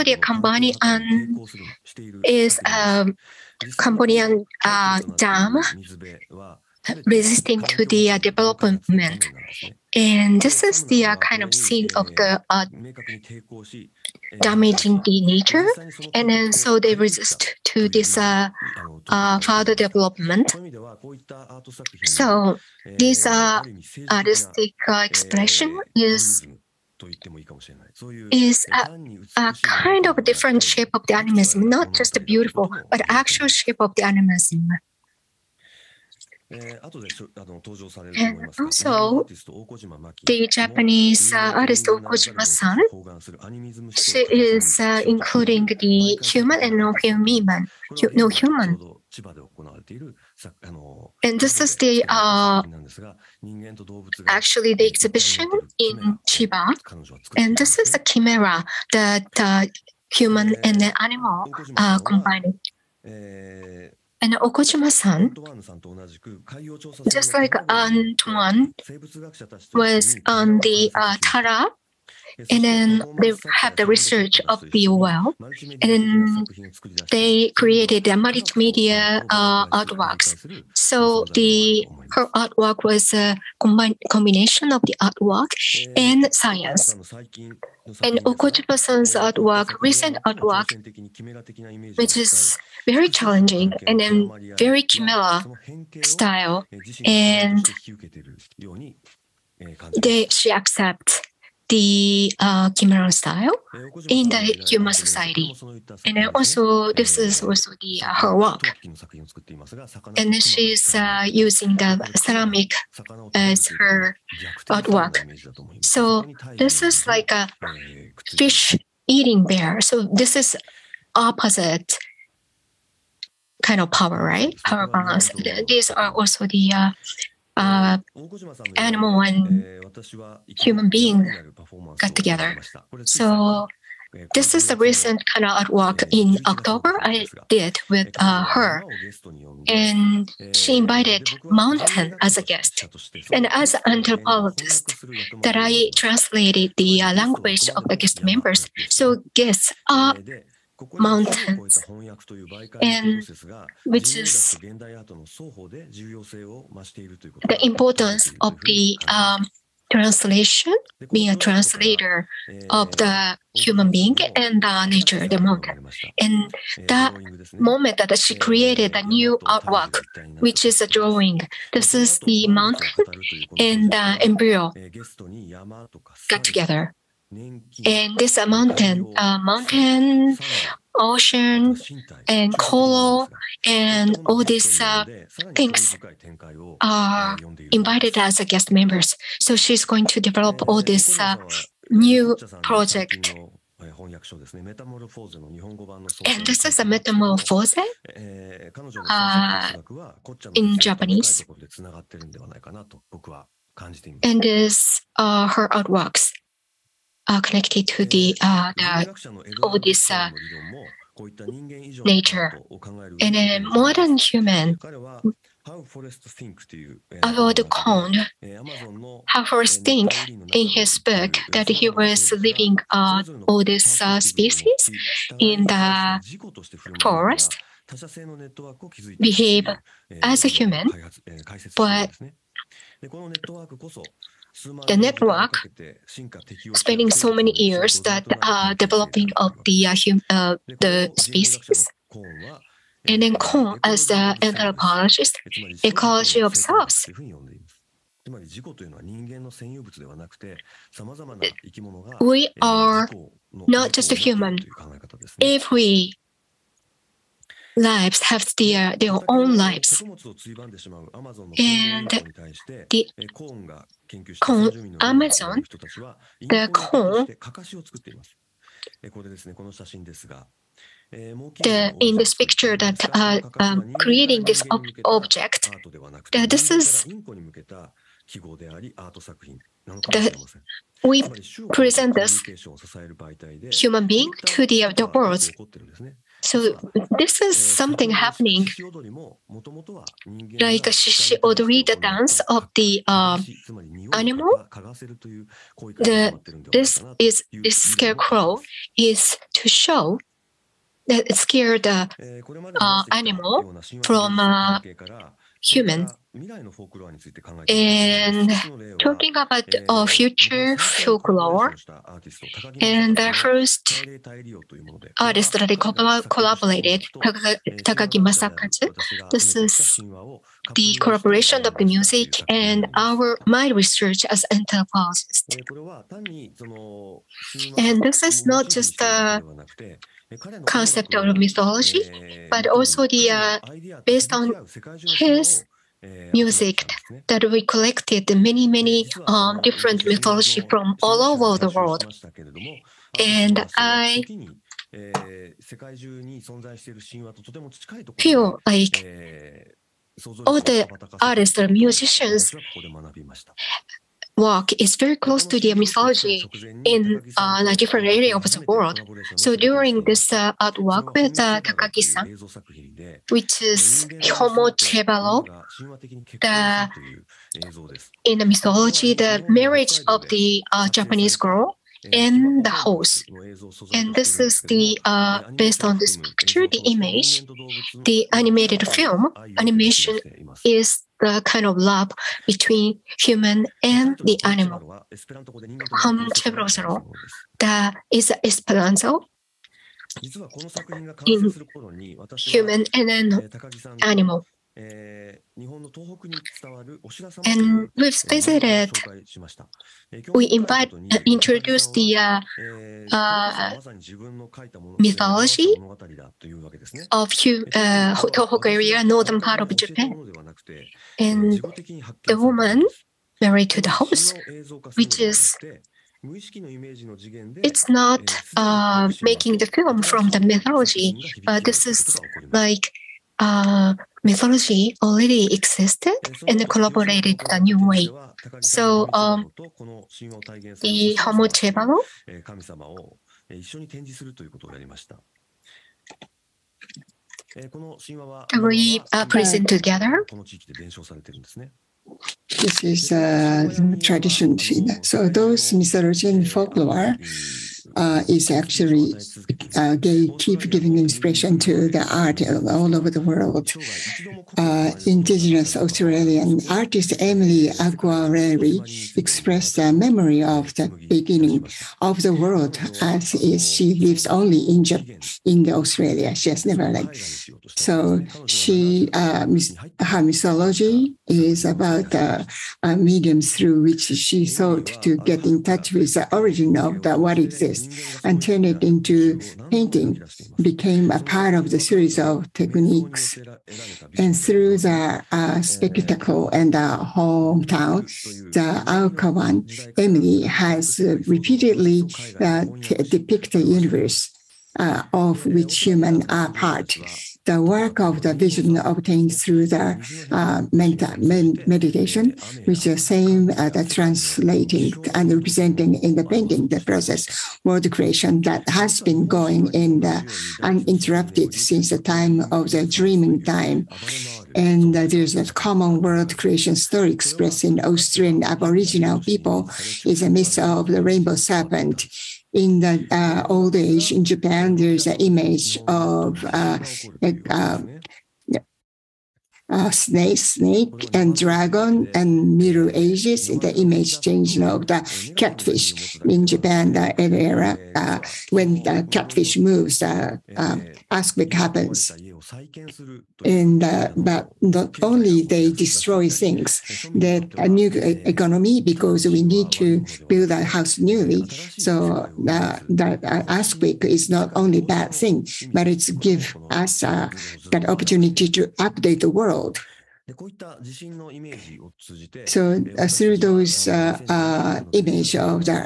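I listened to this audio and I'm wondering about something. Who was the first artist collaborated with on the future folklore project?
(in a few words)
Takagi Masakazu.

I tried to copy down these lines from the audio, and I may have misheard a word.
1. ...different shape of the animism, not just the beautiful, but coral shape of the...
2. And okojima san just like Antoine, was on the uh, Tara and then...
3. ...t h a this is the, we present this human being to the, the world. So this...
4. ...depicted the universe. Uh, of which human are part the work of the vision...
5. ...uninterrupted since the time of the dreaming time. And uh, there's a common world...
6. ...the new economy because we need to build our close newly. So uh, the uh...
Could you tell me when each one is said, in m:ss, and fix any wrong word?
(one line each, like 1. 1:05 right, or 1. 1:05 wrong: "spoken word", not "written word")
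1. 0:30 wrong: "actual", not "coral"
2. 1:04 right
3. 4:36 right
4. 8:12 right
5. 8:30 right
6. 9:07 wrong: "house", not "close".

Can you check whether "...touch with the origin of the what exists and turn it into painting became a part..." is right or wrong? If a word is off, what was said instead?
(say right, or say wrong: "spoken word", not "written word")
right.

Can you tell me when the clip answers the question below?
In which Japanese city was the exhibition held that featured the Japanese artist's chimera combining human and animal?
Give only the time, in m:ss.
0:56.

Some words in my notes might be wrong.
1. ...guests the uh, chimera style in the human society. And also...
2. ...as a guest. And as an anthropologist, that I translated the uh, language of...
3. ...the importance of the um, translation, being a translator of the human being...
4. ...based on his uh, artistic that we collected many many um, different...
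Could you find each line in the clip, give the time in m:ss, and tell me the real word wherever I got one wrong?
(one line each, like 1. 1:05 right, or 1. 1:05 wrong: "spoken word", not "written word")
1. 1:40 wrong: "accepts", not "guests"
2. 2:22 right
3. 2:37 right
4. 5:34 wrong: "music", not "artistic".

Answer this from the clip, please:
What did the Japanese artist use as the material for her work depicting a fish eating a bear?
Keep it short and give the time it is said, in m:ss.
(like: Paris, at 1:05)
Ceramic, at 1:52.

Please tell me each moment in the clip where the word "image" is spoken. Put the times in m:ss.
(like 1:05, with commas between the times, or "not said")
6:16, 8:45, 8:53, 9:24.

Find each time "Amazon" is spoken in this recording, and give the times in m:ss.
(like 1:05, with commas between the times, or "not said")
4:24.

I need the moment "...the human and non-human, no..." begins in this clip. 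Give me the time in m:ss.
0:45.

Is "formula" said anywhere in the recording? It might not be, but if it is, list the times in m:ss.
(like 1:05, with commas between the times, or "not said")
not said.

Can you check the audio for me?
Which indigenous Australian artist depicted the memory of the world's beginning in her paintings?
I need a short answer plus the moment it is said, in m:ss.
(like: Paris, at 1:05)
Emily Kngwarreye, at 7:37.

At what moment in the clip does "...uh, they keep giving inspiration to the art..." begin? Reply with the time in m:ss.
7:29.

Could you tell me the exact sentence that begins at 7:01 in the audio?
but uh, this is like uh, mythology already existed and collaborated a new way.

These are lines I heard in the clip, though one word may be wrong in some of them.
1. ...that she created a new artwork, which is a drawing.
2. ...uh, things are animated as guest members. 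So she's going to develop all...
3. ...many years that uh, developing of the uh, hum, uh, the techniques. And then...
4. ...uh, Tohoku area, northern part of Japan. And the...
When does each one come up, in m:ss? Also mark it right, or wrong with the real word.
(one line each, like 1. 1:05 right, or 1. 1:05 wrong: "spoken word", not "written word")
1. 2:47 right
2. 3:04 wrong: "invited", not "animated"
3. 3:57 wrong: "species", not "techniques"
4. 6:47 right.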